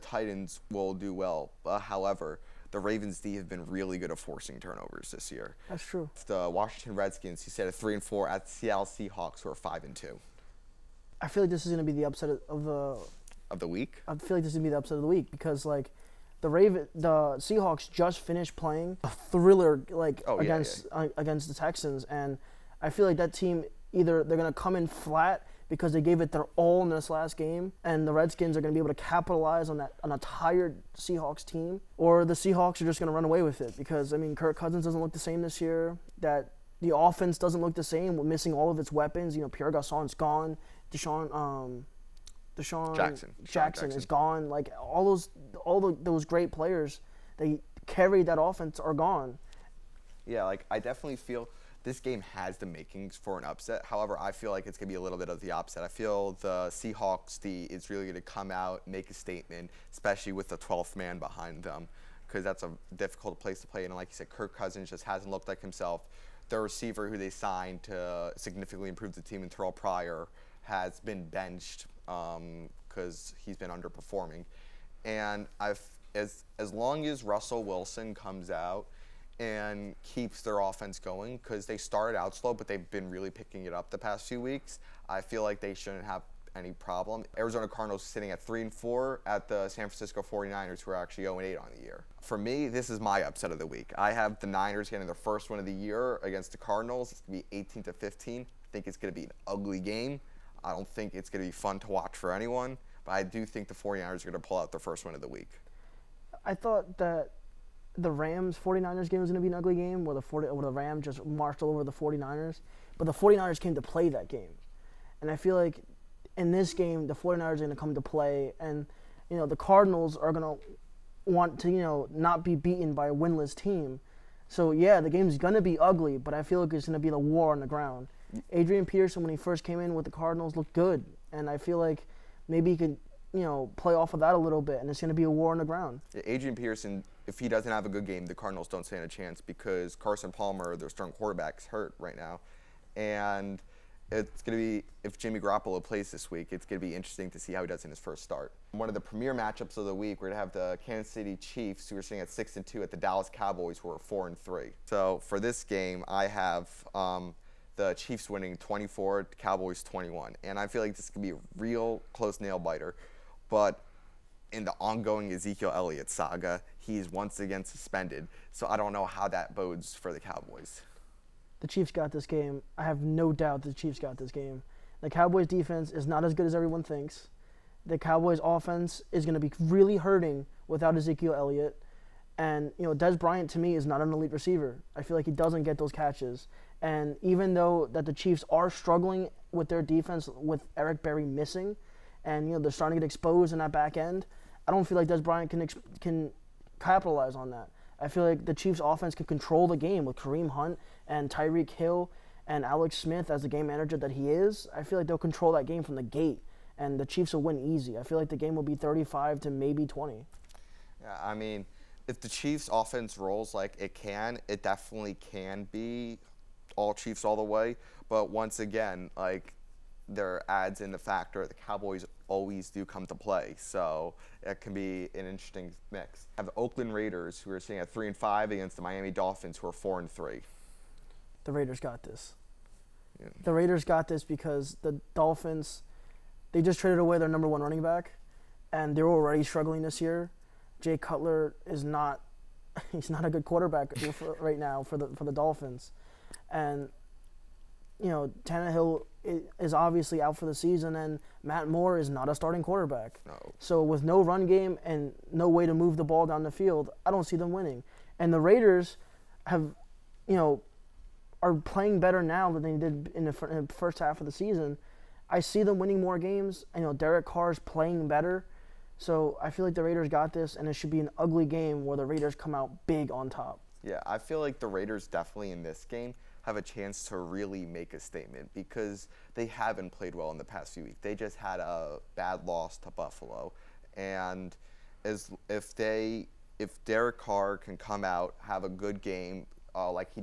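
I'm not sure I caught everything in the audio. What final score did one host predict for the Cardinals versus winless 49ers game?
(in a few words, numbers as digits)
18 to 15.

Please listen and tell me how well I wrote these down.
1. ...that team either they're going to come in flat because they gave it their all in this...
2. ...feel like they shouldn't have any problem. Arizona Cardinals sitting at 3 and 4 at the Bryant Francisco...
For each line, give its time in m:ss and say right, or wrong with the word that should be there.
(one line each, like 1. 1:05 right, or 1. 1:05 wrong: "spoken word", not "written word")
1. 0:23 right
2. 1:25 wrong: "San", not "Bryant".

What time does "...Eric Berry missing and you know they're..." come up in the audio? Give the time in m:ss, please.
3:10.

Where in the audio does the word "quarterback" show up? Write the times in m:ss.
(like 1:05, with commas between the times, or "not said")
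2:21, 4:03, 4:12.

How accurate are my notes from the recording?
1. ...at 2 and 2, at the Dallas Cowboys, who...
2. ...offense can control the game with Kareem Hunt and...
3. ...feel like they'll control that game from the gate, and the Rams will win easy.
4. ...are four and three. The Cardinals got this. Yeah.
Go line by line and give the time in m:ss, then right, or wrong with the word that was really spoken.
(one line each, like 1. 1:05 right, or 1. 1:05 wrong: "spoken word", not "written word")
1. 2:32 wrong: "6", not "2"
2. 3:18 right
3. 3:24 wrong: "Chiefs", not "Rams"
4. 3:49 wrong: "Raiders", not "Cardinals".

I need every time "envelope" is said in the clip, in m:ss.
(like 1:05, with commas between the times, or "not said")
not said.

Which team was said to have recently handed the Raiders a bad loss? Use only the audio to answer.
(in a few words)
Buffalo.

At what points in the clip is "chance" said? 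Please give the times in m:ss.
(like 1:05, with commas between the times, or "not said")
2:19, 4:36.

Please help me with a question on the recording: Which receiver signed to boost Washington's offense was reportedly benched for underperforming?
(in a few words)
Terrelle Pryor.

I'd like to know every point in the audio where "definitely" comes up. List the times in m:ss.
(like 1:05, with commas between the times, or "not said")
0:50, 3:34, 4:35.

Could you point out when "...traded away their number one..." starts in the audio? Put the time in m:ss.
3:56.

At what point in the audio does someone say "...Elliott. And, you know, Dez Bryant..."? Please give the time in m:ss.
3:01.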